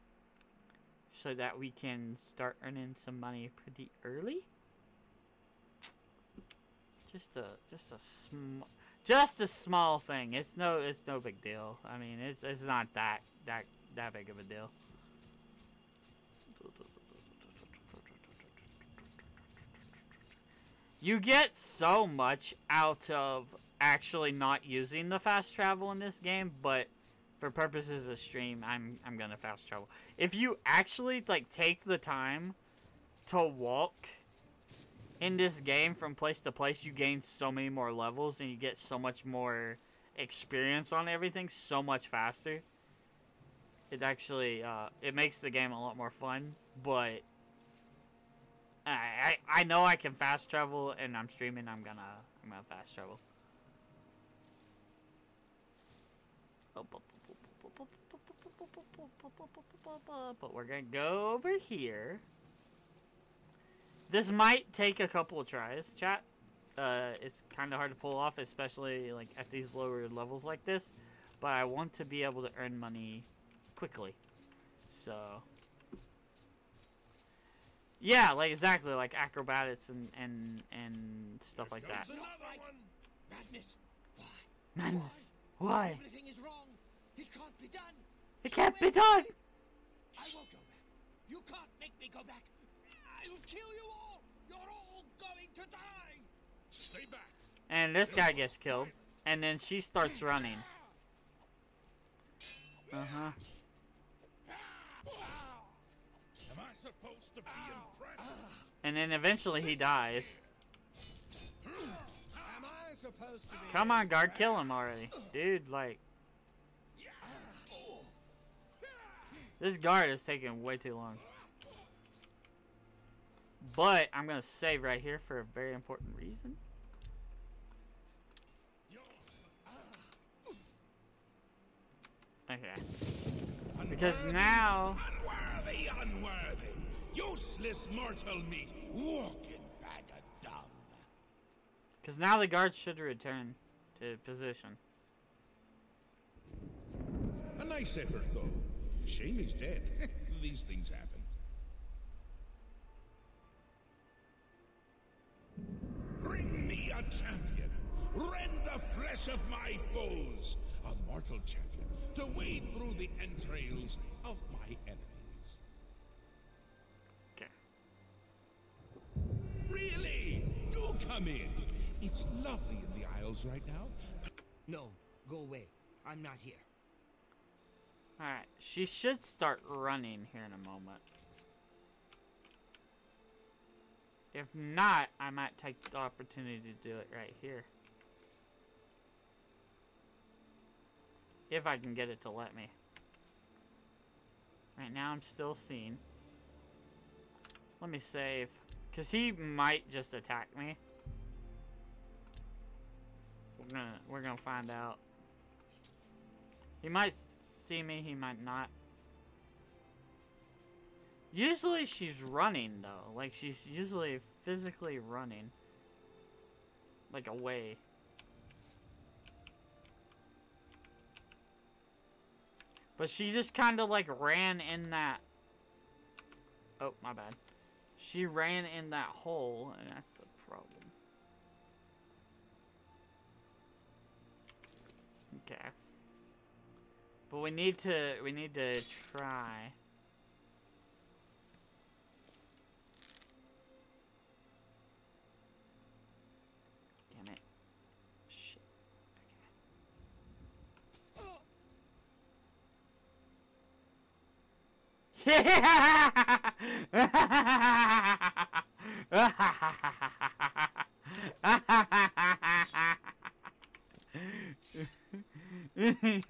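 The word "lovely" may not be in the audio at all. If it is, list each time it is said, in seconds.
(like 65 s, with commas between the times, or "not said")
172 s.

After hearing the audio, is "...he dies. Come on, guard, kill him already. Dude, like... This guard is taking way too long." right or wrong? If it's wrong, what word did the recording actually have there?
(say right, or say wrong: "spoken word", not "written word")
right.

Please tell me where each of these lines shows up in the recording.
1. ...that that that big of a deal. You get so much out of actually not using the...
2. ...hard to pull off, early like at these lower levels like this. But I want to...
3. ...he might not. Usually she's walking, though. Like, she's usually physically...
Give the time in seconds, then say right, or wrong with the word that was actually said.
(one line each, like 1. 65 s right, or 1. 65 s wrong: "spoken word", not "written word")
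1. 12 s right
2. 67 s wrong: "especially", not "early"
3. 208 s wrong: "running", not "walking".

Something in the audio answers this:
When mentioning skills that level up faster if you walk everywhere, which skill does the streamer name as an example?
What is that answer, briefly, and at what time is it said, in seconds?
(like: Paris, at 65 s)
Acrobatics, at 79 s.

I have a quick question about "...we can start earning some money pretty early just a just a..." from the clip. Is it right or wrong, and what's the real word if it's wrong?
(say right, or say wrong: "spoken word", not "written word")
right.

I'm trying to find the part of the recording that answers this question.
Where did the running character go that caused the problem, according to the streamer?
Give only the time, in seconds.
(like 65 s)
228 s.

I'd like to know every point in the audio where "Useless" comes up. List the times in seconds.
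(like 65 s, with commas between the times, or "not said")
137 s.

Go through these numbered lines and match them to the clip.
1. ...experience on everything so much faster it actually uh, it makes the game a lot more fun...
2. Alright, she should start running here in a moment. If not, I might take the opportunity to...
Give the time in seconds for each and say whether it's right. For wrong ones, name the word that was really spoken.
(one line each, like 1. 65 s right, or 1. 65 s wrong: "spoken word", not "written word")
1. 40 s right
2. 178 s right.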